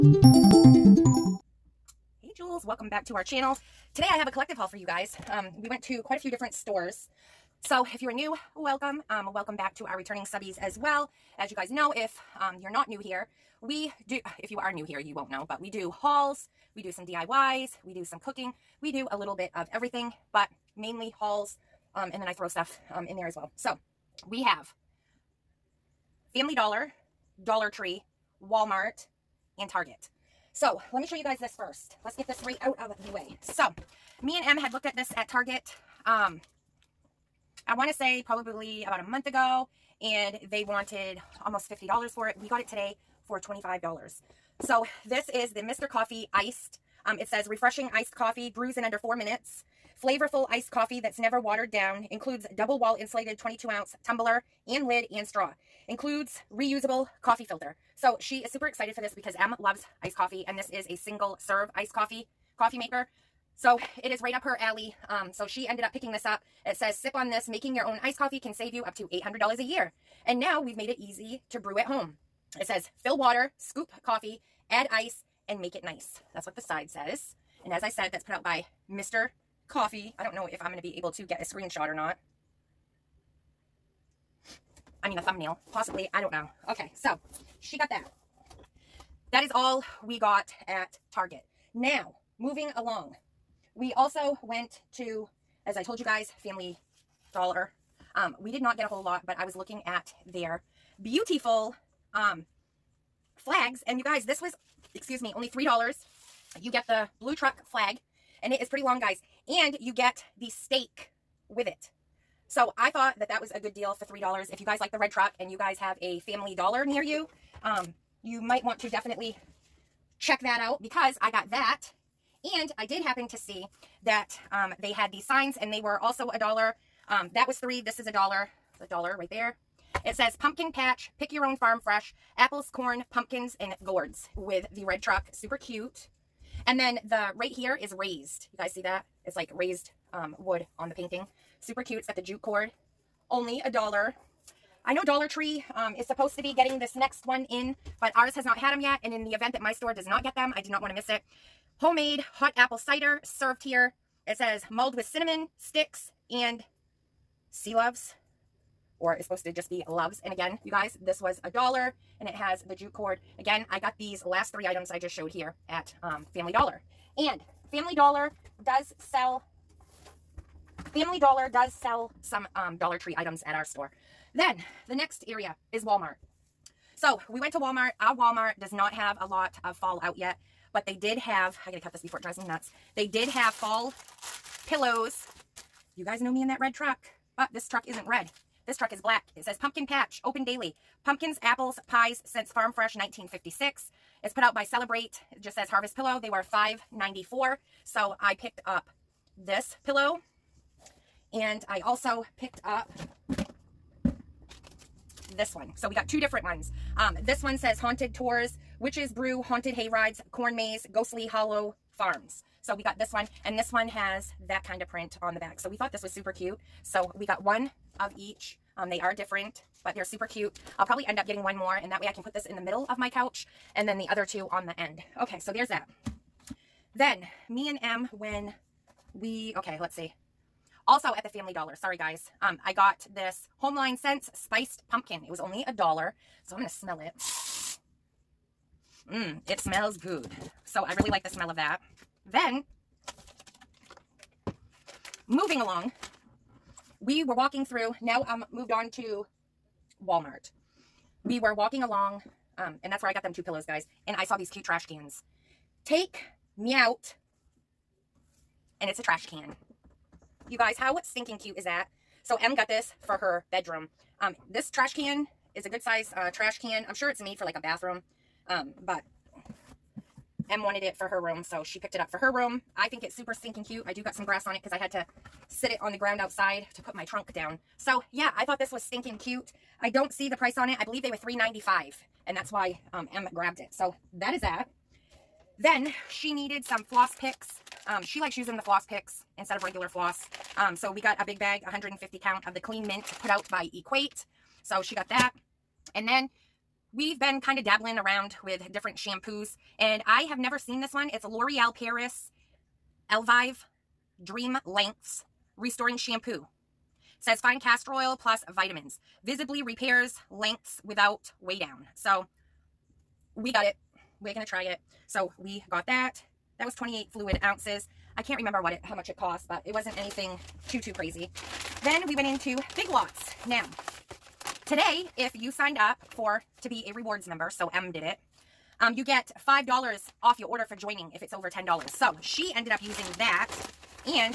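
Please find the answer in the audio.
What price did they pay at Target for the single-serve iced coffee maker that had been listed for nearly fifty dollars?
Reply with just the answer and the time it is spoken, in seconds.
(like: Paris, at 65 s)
$25, at 43 s.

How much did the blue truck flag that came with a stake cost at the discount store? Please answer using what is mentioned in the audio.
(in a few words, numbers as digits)
$3.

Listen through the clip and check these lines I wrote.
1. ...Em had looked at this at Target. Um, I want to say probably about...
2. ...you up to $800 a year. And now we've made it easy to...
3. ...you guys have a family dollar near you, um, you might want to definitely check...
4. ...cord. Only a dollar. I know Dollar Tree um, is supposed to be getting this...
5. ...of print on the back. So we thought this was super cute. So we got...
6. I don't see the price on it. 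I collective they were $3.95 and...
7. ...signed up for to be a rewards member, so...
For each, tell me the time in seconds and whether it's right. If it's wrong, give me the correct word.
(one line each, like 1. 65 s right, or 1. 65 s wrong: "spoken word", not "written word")
1. 34 s right
2. 68 s right
3. 115 s right
4. 142 s right
5. 214 s right
6. 279 s wrong: "believe", not "collective"
7. 325 s right.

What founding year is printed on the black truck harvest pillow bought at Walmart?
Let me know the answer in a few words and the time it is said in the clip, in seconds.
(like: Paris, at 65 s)
1956, at 192 s.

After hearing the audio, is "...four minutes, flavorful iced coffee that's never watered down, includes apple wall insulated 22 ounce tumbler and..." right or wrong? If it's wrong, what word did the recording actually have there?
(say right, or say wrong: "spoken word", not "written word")
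wrong: "double", not "apple".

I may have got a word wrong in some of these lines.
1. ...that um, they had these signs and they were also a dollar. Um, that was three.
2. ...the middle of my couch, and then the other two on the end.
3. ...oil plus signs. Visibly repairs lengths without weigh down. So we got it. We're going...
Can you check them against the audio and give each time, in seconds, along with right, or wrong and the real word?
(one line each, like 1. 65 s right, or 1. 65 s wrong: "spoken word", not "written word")
1. 124 s right
2. 222 s right
3. 307 s wrong: "vitamins", not "signs".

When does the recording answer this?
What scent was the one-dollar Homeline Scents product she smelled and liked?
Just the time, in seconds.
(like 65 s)
234 s.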